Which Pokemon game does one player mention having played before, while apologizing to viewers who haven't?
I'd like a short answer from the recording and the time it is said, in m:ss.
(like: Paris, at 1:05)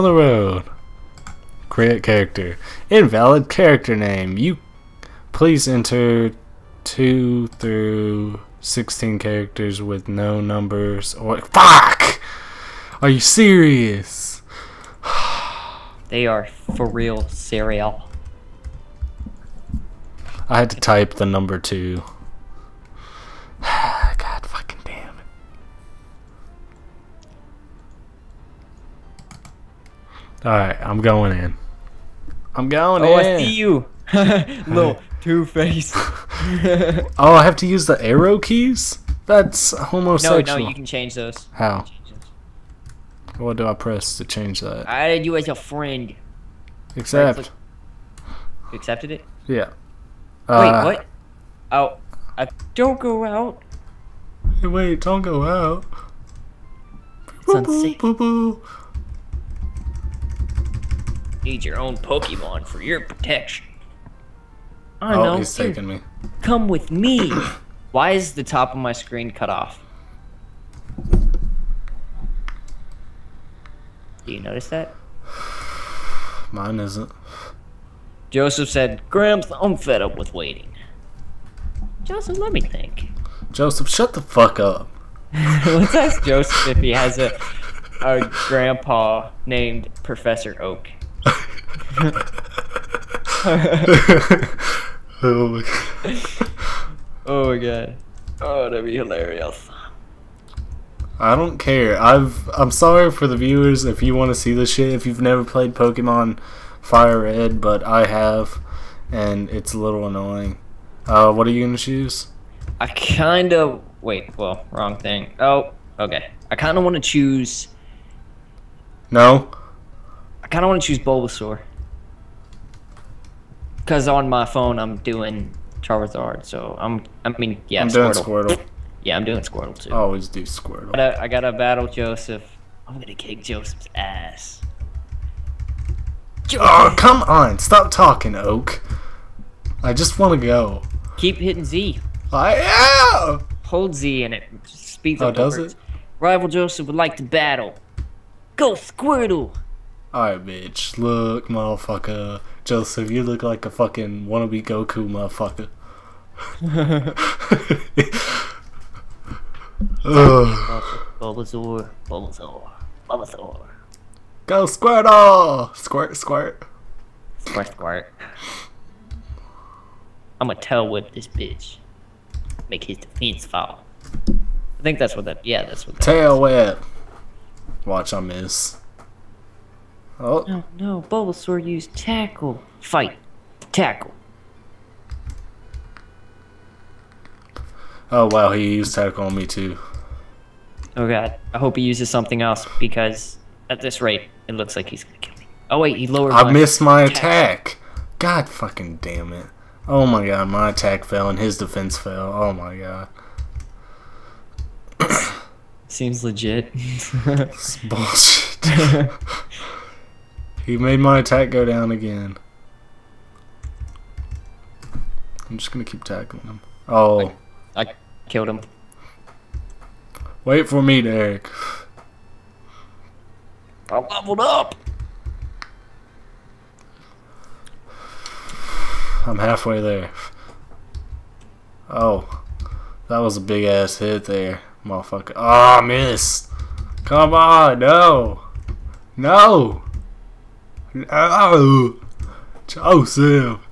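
Pokemon Fire Red, at 1:45.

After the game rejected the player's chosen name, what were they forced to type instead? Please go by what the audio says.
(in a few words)
the number 2.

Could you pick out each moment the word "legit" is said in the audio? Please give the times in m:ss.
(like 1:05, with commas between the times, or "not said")
3:26.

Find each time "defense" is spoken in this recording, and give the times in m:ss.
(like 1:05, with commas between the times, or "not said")
2:52, 3:21.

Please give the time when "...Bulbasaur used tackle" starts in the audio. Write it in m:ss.
3:01.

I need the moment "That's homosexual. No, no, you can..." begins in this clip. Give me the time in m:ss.
0:39.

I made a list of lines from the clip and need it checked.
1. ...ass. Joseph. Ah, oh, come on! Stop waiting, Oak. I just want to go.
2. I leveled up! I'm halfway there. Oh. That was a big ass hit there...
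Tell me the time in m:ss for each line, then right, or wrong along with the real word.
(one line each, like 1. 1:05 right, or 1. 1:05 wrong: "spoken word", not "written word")
1. 2:13 wrong: "talking", not "waiting"
2. 3:43 right.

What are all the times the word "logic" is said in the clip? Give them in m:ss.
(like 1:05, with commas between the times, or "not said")
not said.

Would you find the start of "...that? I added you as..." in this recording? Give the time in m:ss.
0:44.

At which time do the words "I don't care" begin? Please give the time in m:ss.
1:41.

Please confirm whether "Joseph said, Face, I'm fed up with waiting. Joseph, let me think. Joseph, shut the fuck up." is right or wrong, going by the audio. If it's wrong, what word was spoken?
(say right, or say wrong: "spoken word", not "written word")
wrong: "Gramps", not "Face".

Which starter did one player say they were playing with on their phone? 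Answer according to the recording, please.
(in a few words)
Charizard.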